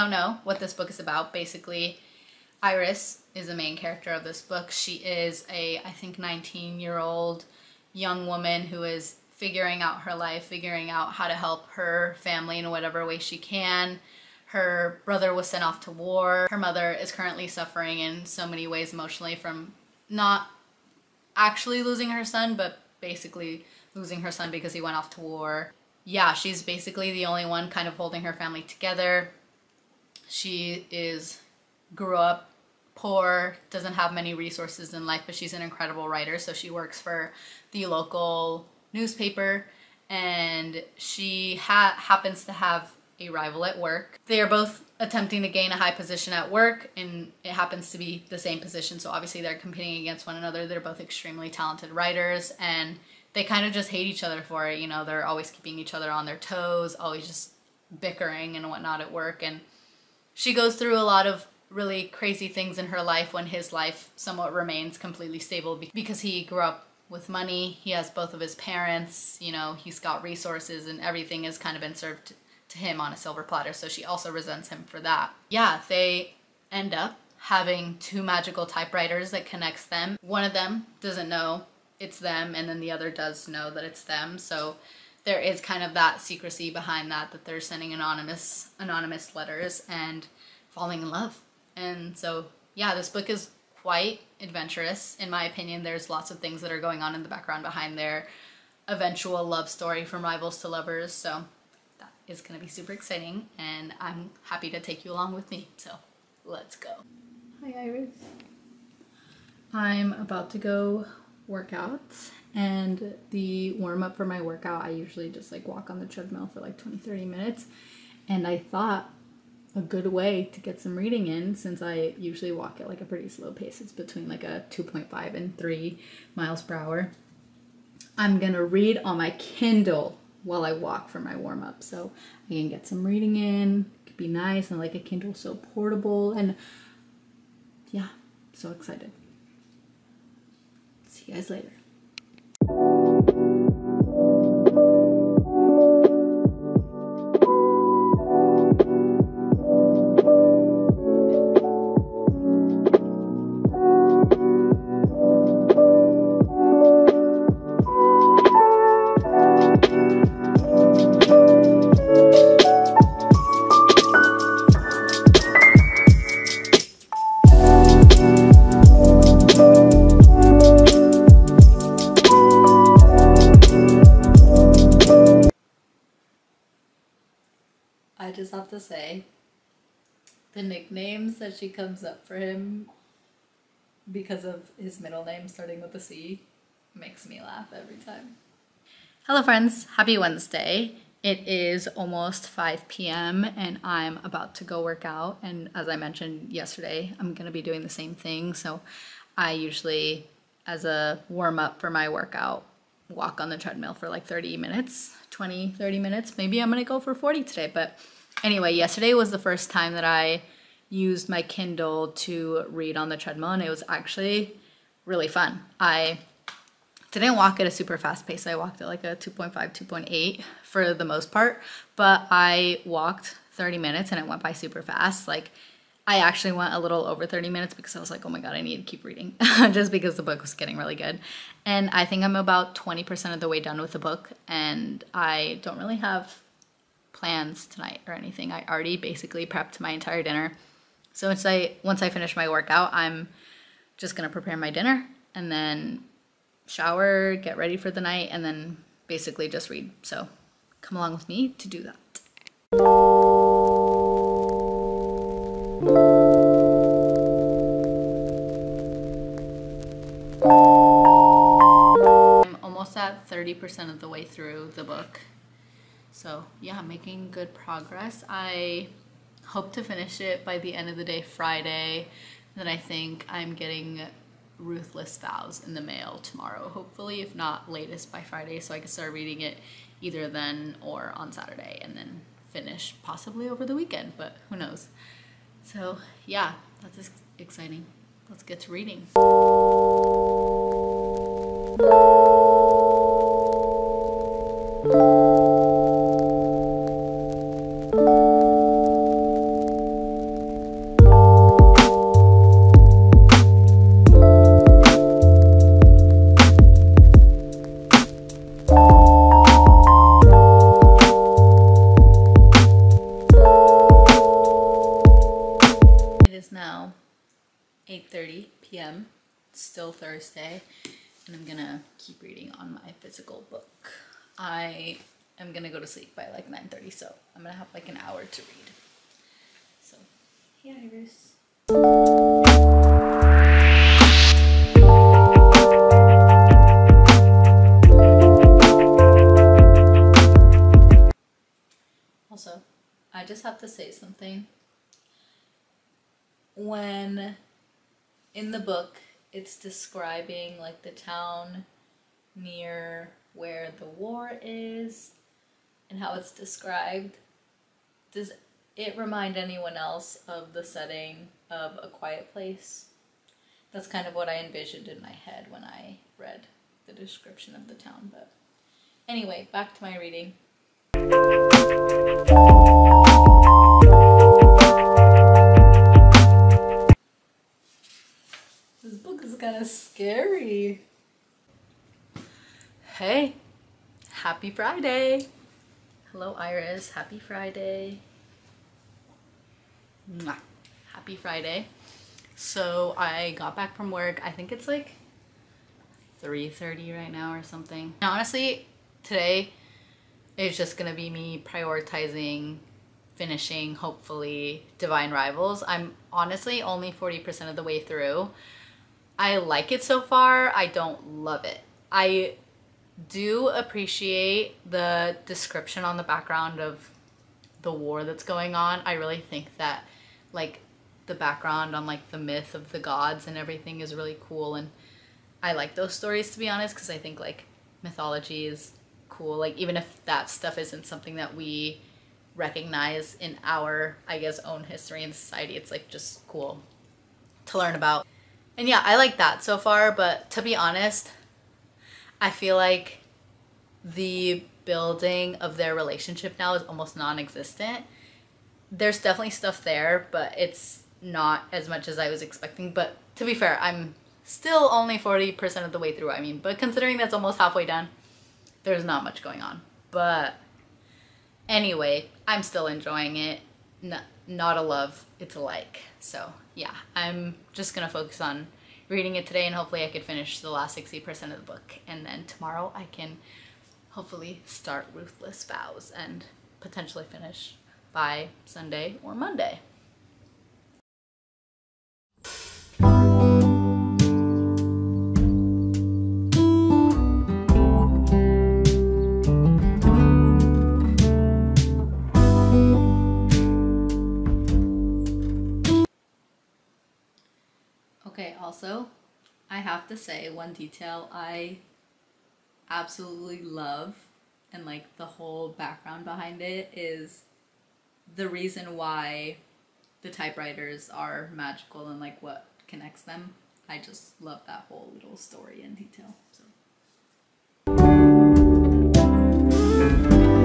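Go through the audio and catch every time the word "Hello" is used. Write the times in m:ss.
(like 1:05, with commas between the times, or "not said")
3:09, 6:26.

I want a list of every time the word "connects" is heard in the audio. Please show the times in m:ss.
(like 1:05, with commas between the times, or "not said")
1:19, 8:32.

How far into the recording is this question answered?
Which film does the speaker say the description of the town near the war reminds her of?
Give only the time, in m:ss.
6:01.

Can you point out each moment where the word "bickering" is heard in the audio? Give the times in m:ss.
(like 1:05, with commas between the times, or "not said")
0:58.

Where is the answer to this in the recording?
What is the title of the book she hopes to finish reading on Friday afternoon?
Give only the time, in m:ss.
6:44.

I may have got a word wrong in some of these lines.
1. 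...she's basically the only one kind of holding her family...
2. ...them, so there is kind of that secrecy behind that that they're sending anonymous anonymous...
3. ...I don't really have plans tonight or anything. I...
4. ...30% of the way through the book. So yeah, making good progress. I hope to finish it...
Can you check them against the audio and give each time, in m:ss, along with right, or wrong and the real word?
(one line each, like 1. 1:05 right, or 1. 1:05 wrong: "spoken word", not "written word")
1. 0:26 right
2. 1:24 right
3. 3:55 right
4. 4:23 right.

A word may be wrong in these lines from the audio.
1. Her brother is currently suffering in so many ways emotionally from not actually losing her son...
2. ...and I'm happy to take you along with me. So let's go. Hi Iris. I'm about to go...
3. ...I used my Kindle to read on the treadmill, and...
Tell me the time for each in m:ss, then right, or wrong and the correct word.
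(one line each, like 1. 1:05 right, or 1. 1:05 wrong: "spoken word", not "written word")
1. 0:16 wrong: "mother", not "brother"
2. 1:43 right
3. 3:30 right.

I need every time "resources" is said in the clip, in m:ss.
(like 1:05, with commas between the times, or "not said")
0:34, 1:10.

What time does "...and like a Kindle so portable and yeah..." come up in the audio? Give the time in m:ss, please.
2:14.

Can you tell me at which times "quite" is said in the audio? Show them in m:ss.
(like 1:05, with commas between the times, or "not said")
1:33.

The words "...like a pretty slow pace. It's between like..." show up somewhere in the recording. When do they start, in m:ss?
2:02.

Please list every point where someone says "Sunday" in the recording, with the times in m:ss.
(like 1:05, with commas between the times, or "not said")
7:58.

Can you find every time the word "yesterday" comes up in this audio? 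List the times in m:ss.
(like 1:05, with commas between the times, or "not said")
3:16, 3:28.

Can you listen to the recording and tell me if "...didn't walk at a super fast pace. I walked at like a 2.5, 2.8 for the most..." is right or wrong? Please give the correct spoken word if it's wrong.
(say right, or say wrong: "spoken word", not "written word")
right.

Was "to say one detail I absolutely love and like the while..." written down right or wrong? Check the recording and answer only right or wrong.
wrong.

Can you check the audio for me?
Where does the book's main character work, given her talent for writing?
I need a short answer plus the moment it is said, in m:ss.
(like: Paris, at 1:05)
local newspaper, at 0:37.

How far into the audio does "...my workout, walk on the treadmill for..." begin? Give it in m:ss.
3:21.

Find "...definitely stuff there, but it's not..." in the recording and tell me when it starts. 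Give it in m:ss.
7:28.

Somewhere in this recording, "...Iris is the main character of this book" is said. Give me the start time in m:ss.
0:02.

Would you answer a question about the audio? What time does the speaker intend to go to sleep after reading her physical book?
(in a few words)
9:30.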